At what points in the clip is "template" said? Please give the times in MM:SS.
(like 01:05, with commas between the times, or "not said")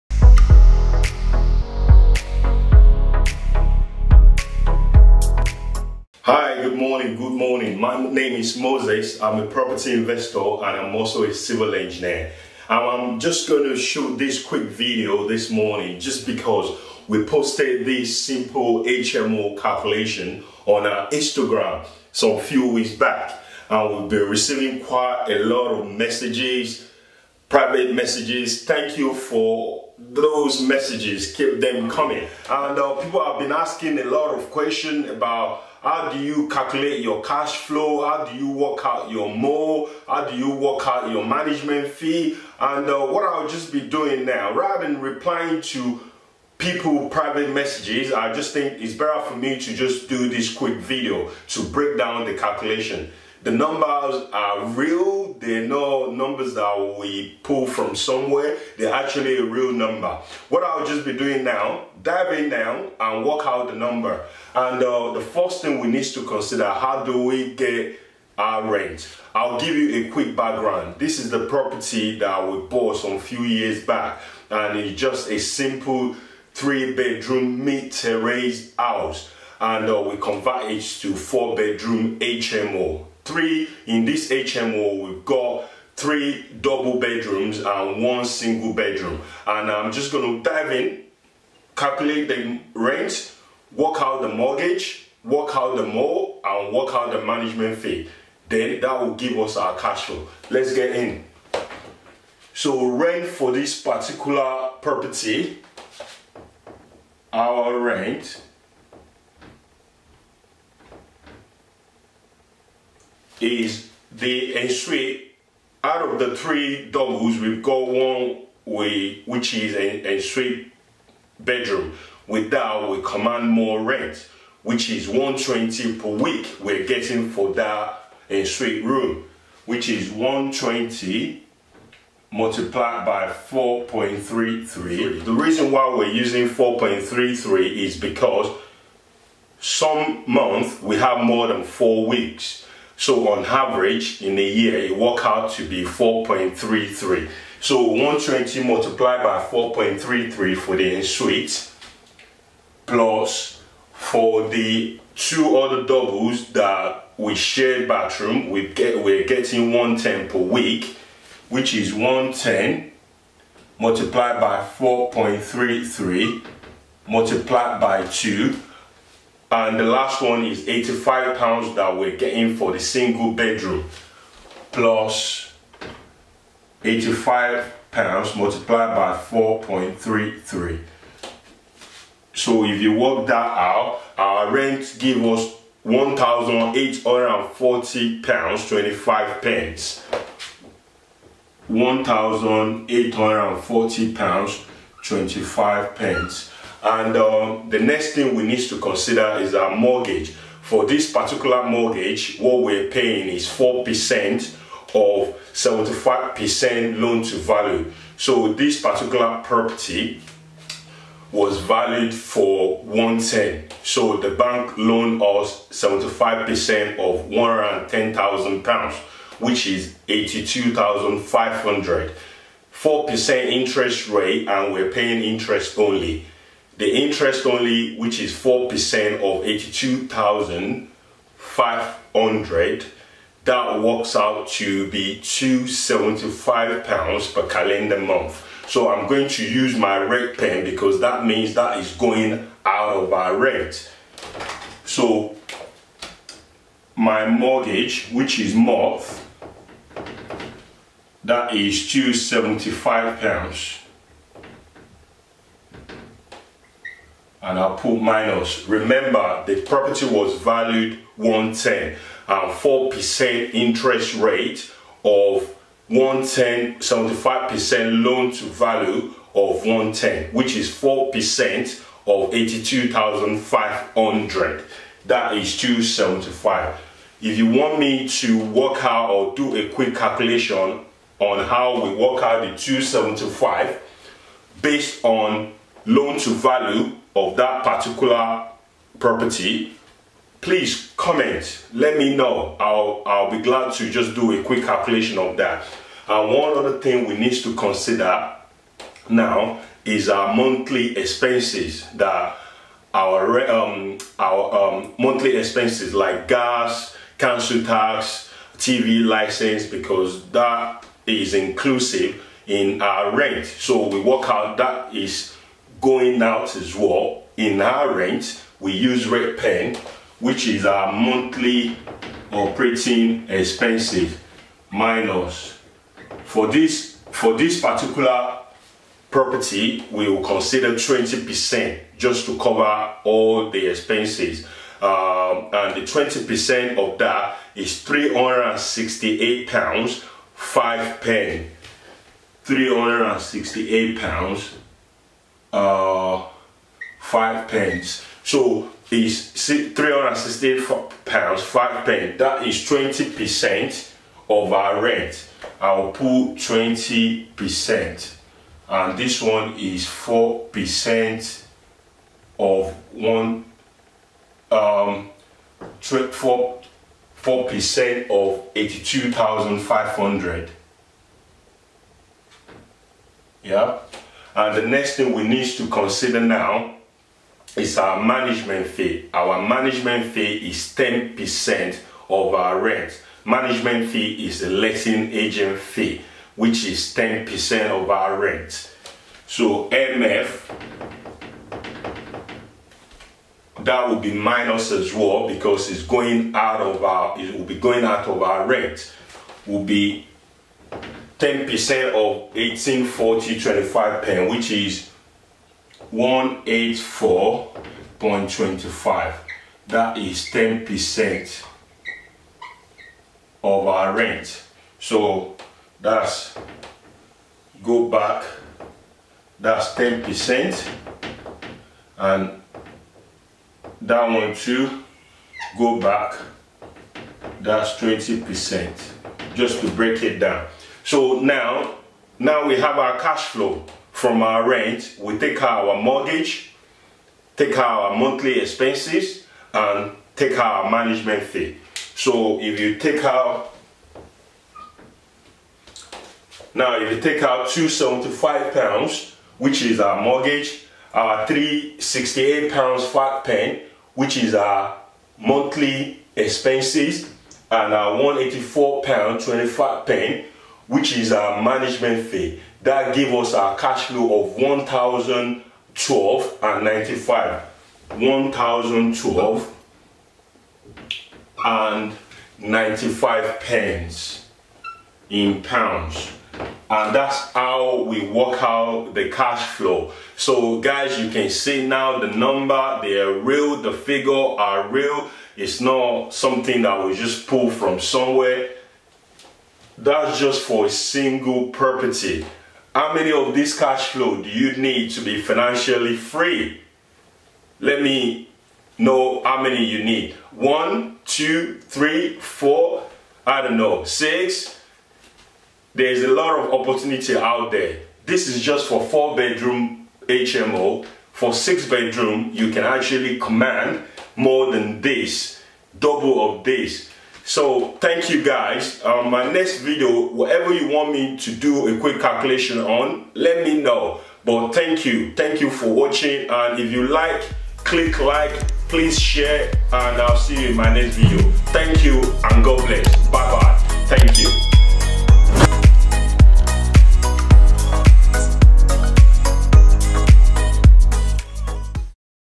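not said.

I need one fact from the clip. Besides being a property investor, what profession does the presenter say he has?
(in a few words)
Civil engineer.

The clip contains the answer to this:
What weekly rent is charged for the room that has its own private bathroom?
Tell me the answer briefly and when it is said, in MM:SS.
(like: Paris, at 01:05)
£120, at 02:05.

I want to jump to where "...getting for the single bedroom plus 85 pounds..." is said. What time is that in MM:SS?
02:52.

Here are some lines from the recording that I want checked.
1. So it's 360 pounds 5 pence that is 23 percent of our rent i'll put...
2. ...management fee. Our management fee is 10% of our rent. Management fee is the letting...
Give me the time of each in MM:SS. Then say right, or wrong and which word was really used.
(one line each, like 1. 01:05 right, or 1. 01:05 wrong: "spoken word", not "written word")
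1. 05:48 wrong: "20", not "23"
2. 06:18 right.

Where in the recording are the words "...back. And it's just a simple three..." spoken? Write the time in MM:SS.
01:13.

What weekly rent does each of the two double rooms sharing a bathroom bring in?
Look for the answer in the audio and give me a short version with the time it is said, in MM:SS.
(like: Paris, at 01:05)
£110, at 02:39.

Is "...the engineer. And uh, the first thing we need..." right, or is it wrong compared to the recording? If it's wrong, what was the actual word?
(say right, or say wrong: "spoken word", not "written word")
wrong: "number", not "engineer".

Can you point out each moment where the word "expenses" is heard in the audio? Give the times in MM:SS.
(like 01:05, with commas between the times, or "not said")
05:00, 05:05, 05:23, 05:33, 07:18, 07:36.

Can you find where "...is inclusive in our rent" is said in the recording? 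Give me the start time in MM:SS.
05:11.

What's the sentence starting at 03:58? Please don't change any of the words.
So I'm going to use my red pen because that means that is going out of our rent.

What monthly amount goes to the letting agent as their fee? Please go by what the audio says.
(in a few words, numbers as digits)
£184.25.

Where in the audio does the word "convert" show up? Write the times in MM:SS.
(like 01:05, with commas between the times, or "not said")
01:20.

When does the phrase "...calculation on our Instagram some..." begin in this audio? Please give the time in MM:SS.
00:19.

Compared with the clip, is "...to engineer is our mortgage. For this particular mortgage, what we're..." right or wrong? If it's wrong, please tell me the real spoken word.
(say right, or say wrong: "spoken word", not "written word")
wrong: "consider", not "engineer".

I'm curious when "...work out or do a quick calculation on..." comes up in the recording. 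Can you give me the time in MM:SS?
04:38.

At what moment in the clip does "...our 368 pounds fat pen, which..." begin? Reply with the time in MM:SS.
07:30.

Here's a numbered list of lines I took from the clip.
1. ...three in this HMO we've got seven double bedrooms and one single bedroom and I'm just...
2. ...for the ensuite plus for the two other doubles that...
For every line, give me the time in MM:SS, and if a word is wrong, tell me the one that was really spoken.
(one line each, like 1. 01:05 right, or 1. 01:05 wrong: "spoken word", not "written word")
1. 01:23 wrong: "three", not "seven"
2. 02:30 right.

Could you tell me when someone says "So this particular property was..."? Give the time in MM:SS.
03:28.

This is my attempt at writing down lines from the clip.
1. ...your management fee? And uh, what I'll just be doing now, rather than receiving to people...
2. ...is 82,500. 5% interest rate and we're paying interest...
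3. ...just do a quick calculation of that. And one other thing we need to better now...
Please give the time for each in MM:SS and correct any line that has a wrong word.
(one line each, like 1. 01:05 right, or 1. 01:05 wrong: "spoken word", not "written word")
1. 00:41 wrong: "replying", not "receiving"
2. 03:39 wrong: "4", not "5"
3. 04:53 wrong: "consider", not "better".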